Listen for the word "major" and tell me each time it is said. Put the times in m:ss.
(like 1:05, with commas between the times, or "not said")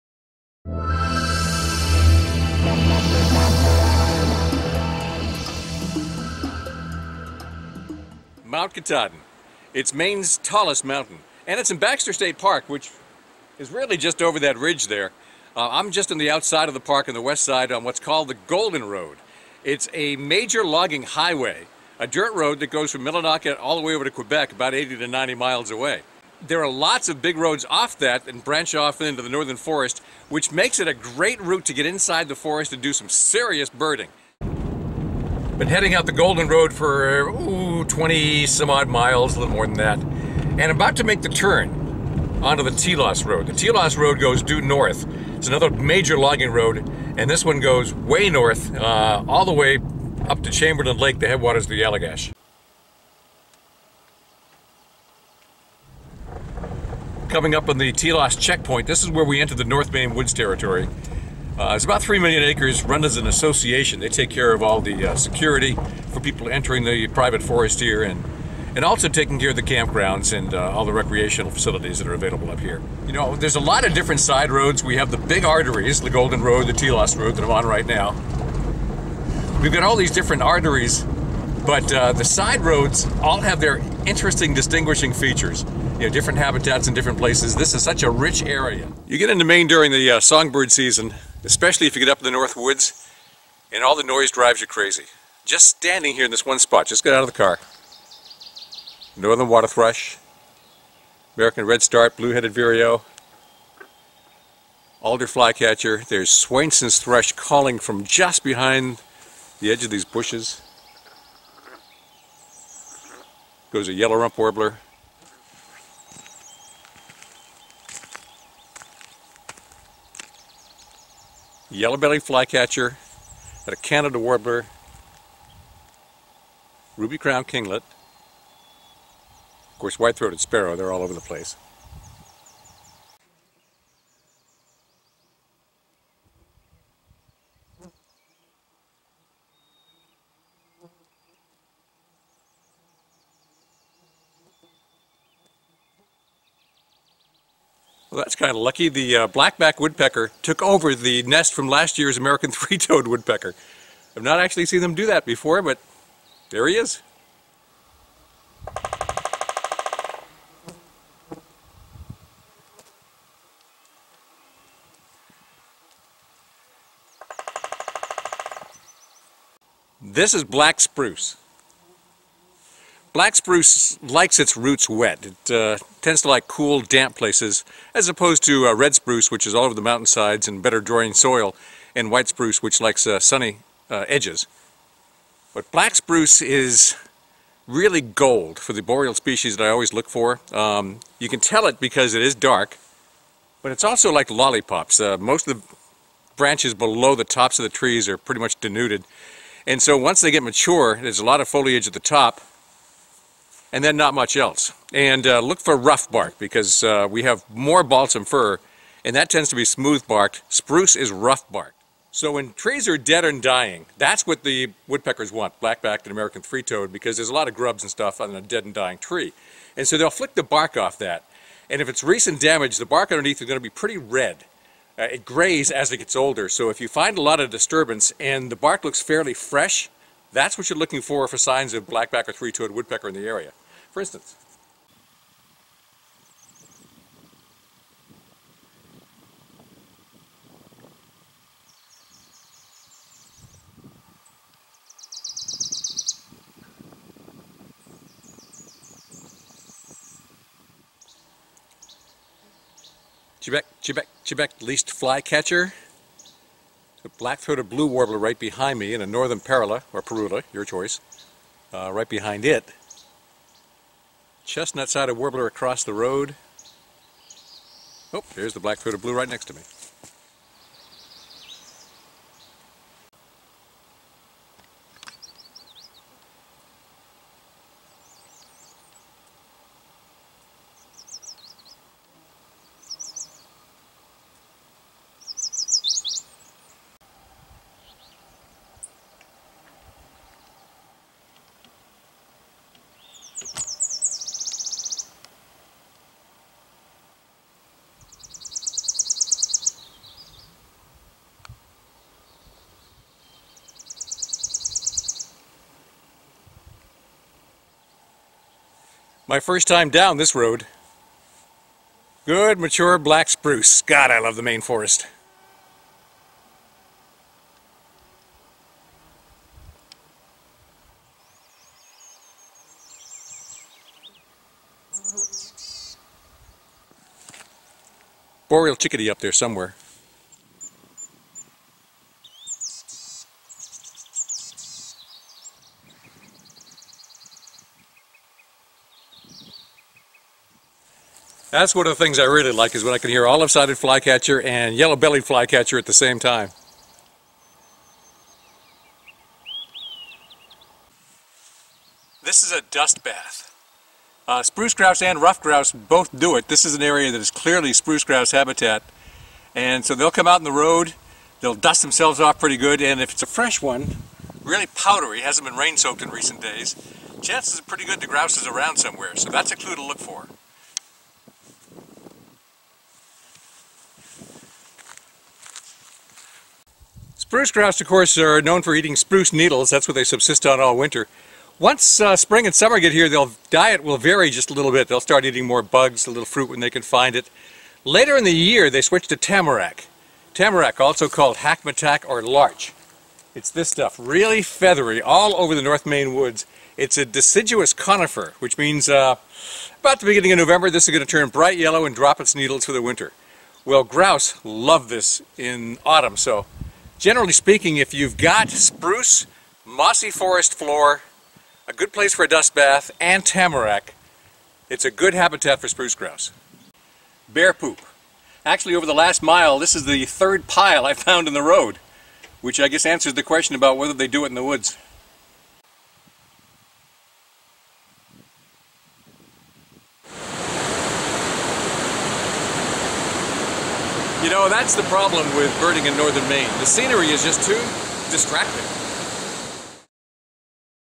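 0:20, 0:45.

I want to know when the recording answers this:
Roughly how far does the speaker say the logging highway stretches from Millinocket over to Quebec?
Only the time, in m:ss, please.
0:24.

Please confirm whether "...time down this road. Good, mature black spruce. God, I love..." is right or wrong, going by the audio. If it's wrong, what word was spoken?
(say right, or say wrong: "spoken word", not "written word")
right.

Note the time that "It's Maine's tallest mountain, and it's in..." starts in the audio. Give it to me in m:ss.
0:09.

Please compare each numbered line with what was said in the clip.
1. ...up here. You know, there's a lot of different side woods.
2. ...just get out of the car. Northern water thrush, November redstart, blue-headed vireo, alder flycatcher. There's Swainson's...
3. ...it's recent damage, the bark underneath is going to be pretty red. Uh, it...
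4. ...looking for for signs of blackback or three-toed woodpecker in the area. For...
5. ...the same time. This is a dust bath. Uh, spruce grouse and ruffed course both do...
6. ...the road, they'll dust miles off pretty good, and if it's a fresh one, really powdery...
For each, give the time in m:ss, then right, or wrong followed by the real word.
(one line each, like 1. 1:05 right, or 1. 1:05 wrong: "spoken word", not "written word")
1. 1:12 wrong: "roads", not "woods"
2. 1:36 wrong: "American", not "November"
3. 3:41 right
4. 3:50 right
5. 5:45 wrong: "grouse", not "course"
6. 6:00 wrong: "themselves", not "miles".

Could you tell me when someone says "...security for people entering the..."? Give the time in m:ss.
1:05.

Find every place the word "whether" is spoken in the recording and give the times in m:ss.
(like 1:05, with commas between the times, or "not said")
7:03.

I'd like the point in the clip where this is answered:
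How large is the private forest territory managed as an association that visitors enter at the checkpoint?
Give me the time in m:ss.
1:02.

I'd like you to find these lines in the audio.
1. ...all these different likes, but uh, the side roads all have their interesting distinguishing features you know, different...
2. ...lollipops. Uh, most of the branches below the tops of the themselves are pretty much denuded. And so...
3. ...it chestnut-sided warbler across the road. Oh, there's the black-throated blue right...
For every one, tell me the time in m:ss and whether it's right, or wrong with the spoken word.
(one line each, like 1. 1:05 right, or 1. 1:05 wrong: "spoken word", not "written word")
1. 1:19 wrong: "arteries", not "likes"
2. 3:14 wrong: "trees", not "themselves"
3. 4:22 right.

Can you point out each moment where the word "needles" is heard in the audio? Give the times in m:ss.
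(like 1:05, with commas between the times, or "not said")
6:19, 6:42.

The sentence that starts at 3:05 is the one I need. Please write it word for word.
But black spruce is really gold for the boreal species that I always look for.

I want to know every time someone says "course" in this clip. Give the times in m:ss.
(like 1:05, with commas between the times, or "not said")
2:09, 6:17.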